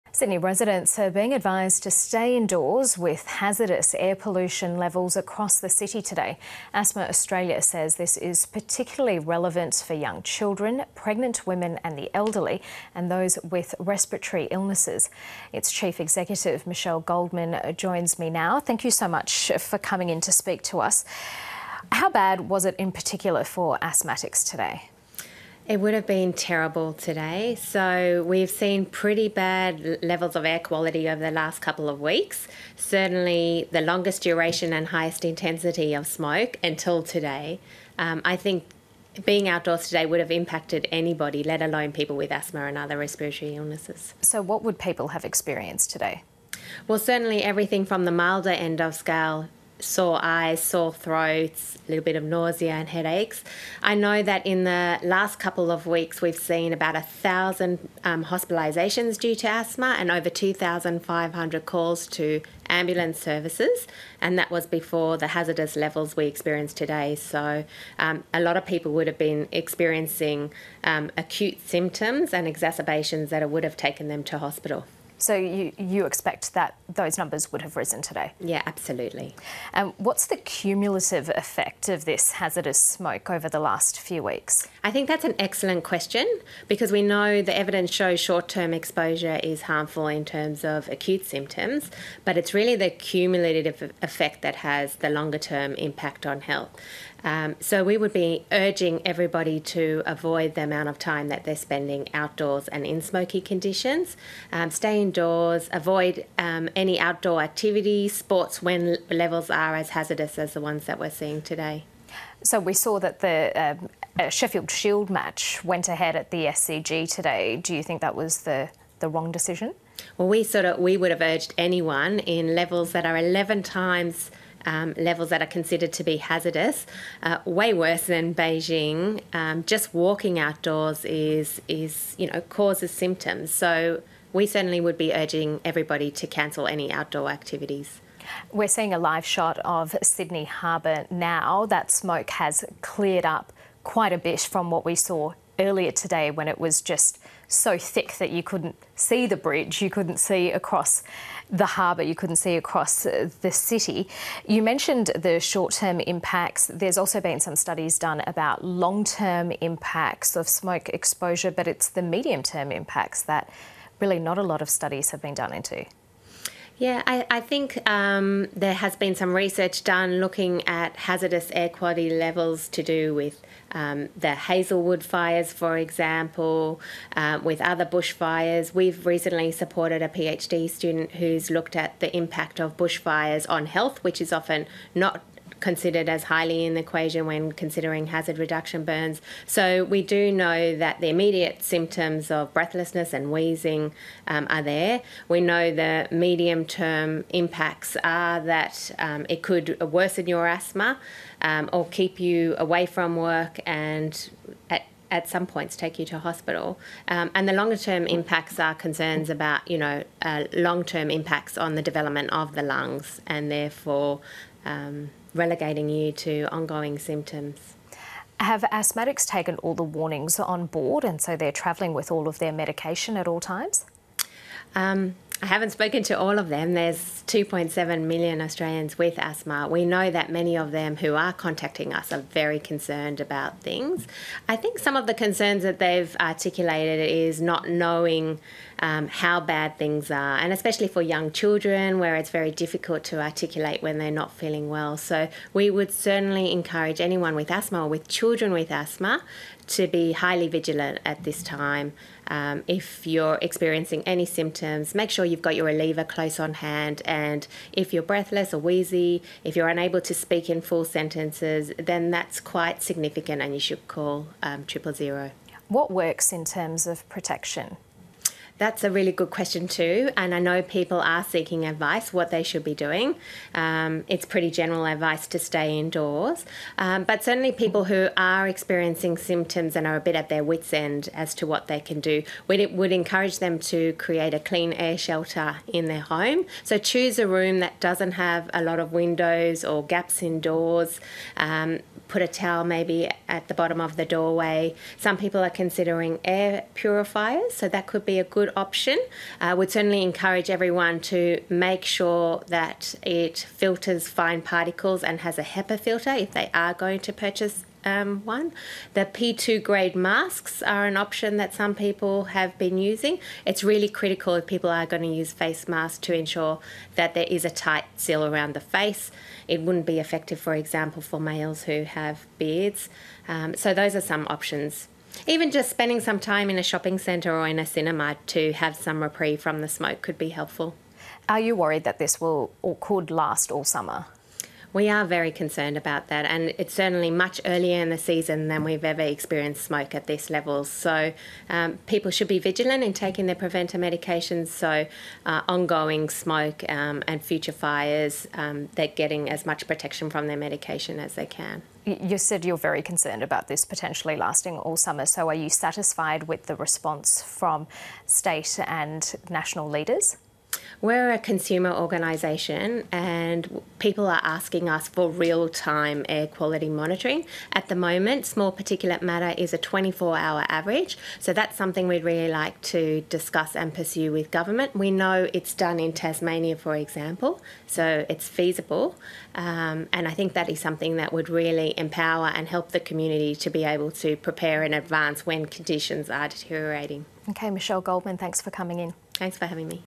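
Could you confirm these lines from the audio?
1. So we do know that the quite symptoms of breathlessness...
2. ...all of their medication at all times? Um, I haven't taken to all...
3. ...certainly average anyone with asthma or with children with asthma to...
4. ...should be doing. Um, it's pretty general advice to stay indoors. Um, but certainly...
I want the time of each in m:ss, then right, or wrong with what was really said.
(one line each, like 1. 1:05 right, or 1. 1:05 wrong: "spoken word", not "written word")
1. 3:09 wrong: "immediate", not "quite"
2. 3:42 wrong: "spoken", not "taken"
3. 4:05 wrong: "encourage", not "average"
4. 4:32 right.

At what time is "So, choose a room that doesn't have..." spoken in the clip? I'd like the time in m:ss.
4:46.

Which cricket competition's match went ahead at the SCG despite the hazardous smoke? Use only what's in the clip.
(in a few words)
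Sheffield Shield.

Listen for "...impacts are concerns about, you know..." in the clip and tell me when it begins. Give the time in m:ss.
3:28.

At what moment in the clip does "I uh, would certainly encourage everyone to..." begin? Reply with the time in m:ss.
4:59.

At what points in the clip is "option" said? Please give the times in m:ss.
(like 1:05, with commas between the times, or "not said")
4:58, 5:10, 5:24.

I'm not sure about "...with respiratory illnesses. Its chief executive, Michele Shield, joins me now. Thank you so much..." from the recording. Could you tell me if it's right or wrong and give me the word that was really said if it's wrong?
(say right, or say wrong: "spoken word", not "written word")
wrong: "Goldman", not "Shield".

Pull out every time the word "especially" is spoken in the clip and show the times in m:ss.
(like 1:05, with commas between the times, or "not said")
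4:00.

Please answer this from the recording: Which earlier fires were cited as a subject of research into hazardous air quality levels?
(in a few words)
Hazelwood fires.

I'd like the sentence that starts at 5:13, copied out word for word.
It's really critical if people are going to use face masks to ensure that there is a tight seal around the face.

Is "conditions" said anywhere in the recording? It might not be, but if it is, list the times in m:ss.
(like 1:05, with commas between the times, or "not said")
1:43, 6:25.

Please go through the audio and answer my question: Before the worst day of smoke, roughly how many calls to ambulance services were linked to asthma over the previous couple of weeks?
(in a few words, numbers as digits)
2,500.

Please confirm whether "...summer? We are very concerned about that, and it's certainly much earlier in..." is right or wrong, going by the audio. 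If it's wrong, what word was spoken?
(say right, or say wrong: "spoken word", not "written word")
right.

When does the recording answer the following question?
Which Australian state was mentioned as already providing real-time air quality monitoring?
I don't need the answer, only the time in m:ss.
6:15.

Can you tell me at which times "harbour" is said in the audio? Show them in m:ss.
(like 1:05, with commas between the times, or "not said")
2:20, 2:31.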